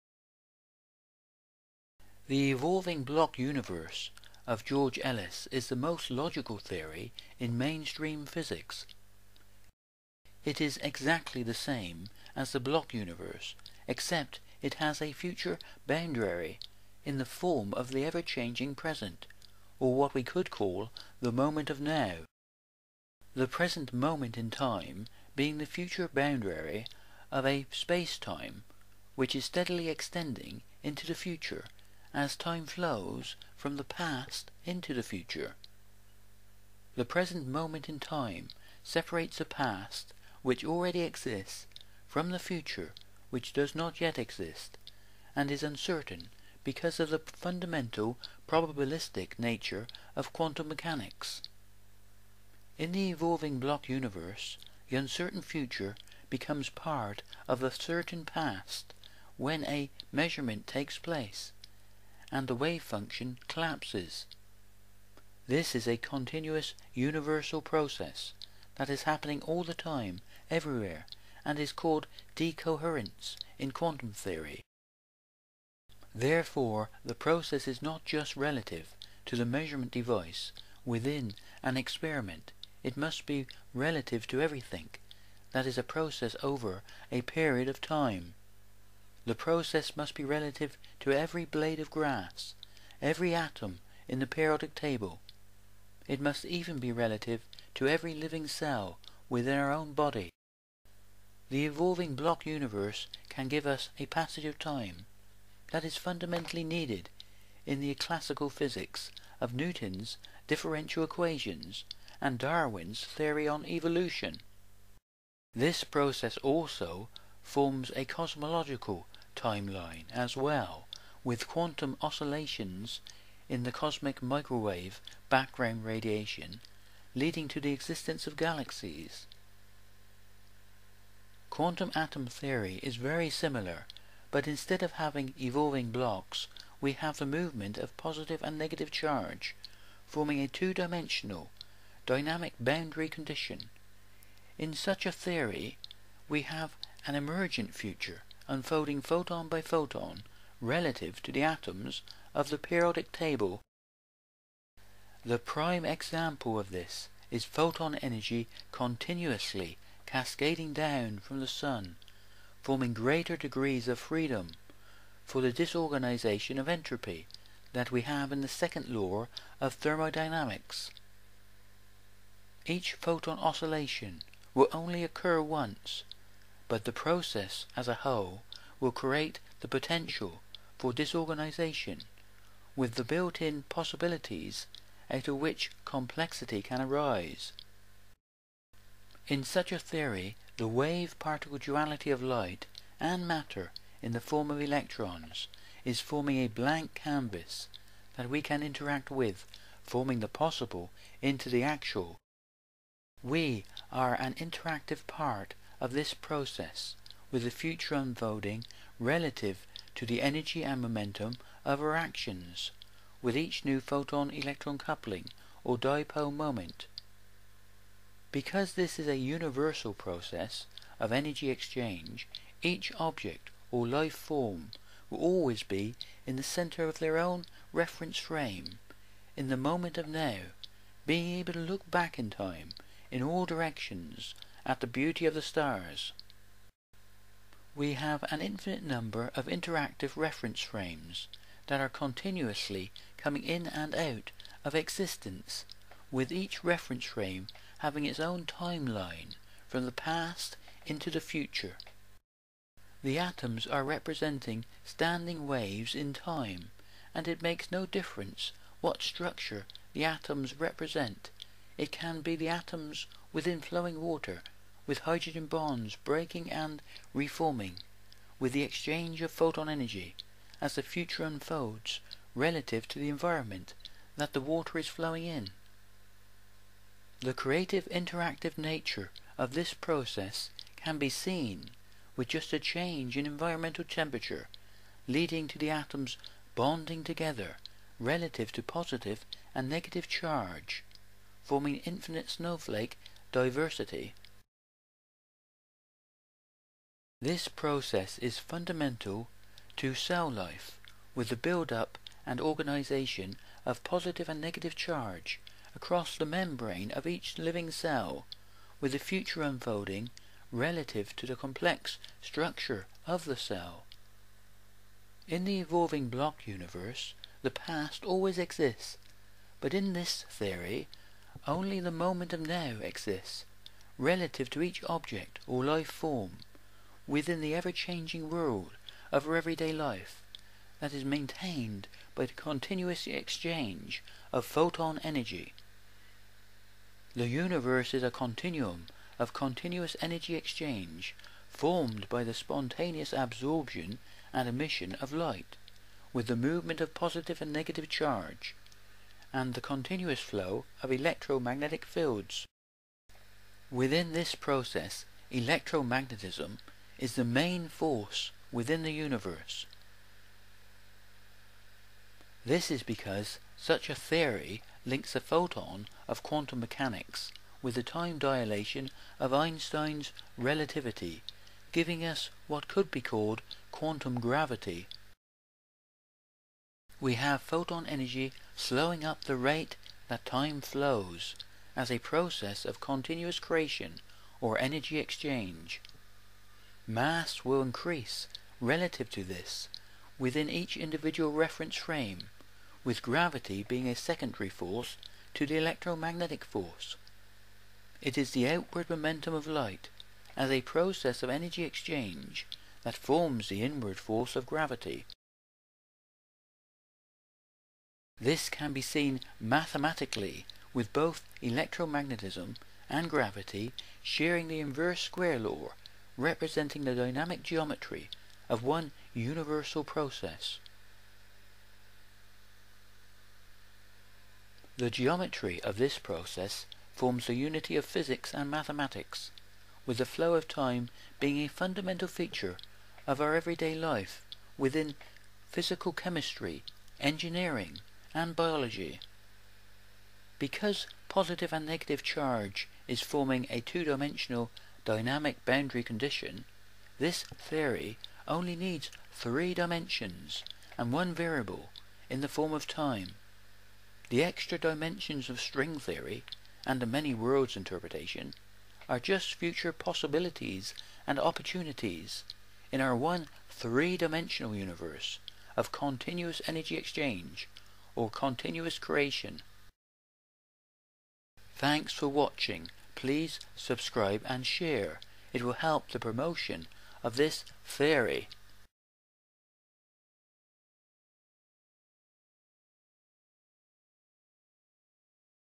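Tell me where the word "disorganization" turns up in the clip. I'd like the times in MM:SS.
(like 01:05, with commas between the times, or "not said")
02:45, 03:00.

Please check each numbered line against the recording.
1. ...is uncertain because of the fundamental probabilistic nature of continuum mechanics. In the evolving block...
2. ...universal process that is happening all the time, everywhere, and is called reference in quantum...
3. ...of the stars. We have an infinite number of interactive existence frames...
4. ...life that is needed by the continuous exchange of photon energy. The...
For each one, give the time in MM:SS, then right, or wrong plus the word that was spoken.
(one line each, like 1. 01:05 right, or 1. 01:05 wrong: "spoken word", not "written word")
1. 00:45 wrong: "quantum", not "continuum"
2. 01:06 wrong: "decoherence", not "reference"
3. 03:55 wrong: "reference", not "existence"
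4. 05:29 wrong: "maintained", not "needed".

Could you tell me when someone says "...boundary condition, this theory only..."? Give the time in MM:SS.
07:25.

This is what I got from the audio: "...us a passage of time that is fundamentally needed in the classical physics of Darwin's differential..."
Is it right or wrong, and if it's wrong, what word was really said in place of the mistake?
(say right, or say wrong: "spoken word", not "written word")
wrong: "Newton", not "Darwin".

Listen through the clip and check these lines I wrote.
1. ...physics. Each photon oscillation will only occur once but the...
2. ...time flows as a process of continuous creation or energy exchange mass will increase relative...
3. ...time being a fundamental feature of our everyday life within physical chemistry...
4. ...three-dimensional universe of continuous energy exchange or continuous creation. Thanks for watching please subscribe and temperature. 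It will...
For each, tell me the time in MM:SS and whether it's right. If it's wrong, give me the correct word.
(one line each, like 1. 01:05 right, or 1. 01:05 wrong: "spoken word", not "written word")
1. 02:49 wrong: "thermodynamics", not "physics"
2. 06:20 right
3. 07:10 right
4. 07:43 wrong: "share", not "temperature".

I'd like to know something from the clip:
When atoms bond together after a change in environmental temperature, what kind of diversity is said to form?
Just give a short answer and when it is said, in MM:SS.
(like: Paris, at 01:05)
snowflake diversity, at 04:52.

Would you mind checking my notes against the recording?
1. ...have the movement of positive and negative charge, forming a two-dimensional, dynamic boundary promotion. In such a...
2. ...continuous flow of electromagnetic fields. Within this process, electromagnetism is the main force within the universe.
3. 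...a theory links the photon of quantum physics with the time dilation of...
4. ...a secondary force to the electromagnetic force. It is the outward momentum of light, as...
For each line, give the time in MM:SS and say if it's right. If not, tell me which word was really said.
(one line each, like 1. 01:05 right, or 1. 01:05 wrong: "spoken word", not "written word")
1. 02:16 wrong: "condition", not "promotion"
2. 05:49 right
3. 06:03 wrong: "mechanics", not "physics"
4. 06:33 right.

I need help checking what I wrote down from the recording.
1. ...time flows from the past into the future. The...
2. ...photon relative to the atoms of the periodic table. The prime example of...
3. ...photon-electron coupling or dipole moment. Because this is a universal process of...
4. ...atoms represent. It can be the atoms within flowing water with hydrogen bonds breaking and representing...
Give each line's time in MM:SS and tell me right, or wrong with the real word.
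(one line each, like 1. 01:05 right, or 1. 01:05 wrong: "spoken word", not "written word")
1. 00:32 right
2. 02:29 right
3. 03:33 right
4. 04:20 wrong: "reforming", not "representing".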